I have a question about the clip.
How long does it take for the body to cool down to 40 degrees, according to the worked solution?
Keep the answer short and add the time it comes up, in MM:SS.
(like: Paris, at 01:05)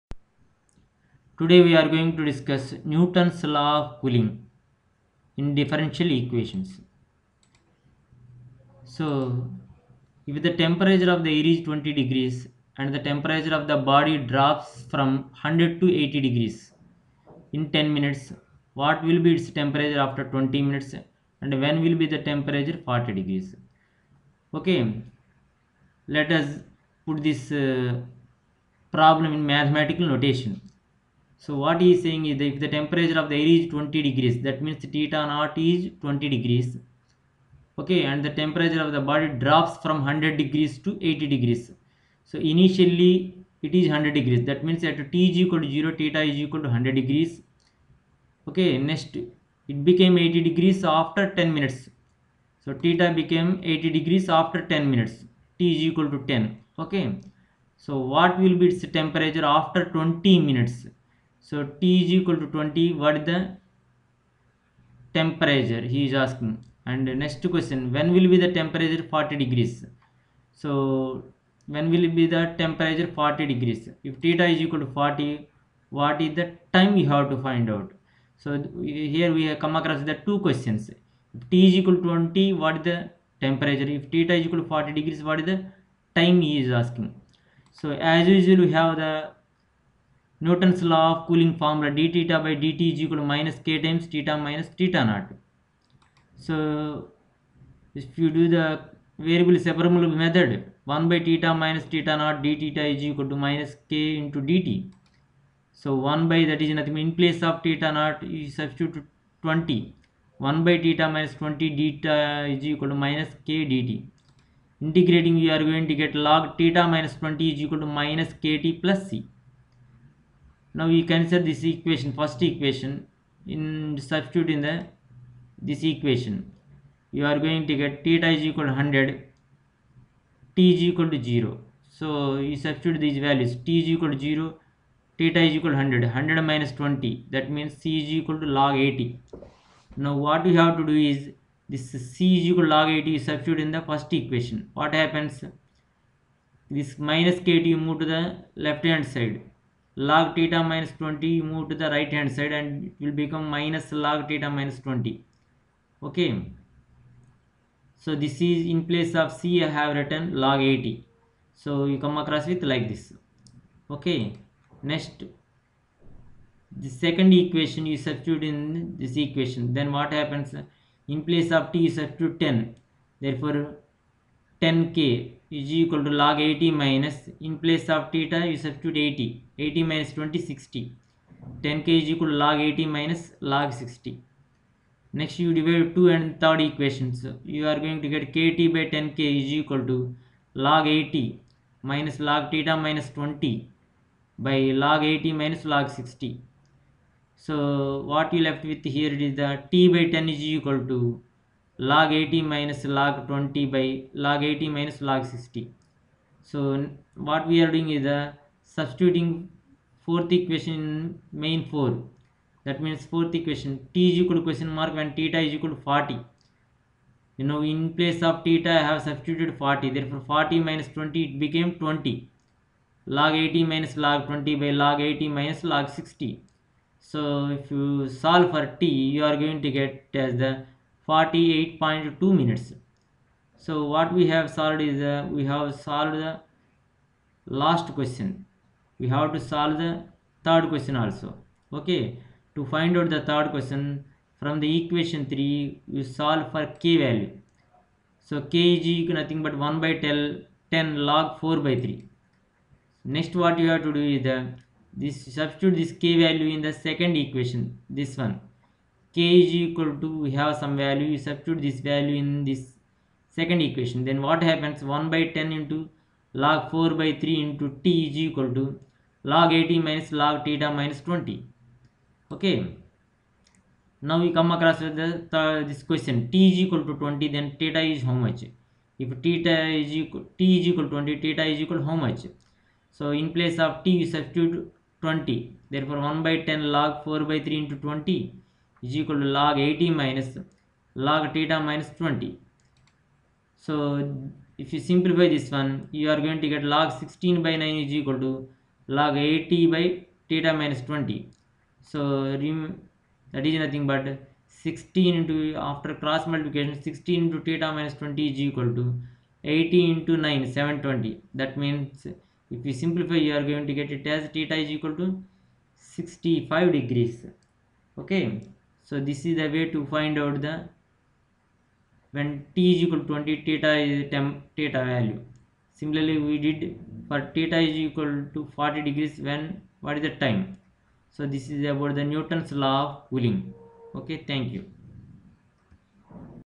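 48.2 minutes, at 03:51.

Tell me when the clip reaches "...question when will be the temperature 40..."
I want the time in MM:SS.
01:07.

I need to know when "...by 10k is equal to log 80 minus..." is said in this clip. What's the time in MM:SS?
03:08.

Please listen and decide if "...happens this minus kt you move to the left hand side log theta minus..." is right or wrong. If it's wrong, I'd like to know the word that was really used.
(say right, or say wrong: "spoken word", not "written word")
right.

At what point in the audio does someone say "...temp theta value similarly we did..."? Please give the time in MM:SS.
05:24.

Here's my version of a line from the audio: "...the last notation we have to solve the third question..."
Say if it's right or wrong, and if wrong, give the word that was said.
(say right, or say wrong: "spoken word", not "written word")
wrong: "question", not "notation".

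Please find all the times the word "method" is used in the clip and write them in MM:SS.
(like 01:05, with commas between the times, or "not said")
01:40.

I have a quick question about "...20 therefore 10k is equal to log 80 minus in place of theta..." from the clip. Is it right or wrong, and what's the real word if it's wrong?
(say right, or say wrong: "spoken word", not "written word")
wrong: "10", not "20".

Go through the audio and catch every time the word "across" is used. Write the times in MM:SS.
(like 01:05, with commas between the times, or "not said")
01:19, 02:42, 04:34.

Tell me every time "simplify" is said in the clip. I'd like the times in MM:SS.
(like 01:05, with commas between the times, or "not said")
04:54, 05:12.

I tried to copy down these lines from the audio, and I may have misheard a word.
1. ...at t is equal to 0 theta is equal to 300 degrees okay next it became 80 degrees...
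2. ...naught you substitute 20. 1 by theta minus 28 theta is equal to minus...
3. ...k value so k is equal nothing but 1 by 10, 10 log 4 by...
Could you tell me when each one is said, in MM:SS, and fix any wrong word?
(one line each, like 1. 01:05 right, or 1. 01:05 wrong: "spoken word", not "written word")
1. 00:44 wrong: "100", not "300"
2. 01:47 wrong: "20", not "28"
3. 04:06 right.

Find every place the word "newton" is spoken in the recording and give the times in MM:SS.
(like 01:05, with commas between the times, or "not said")
00:02, 01:30, 05:32.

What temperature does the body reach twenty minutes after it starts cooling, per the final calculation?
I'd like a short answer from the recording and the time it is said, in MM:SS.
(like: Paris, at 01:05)
65 degrees, at 05:15.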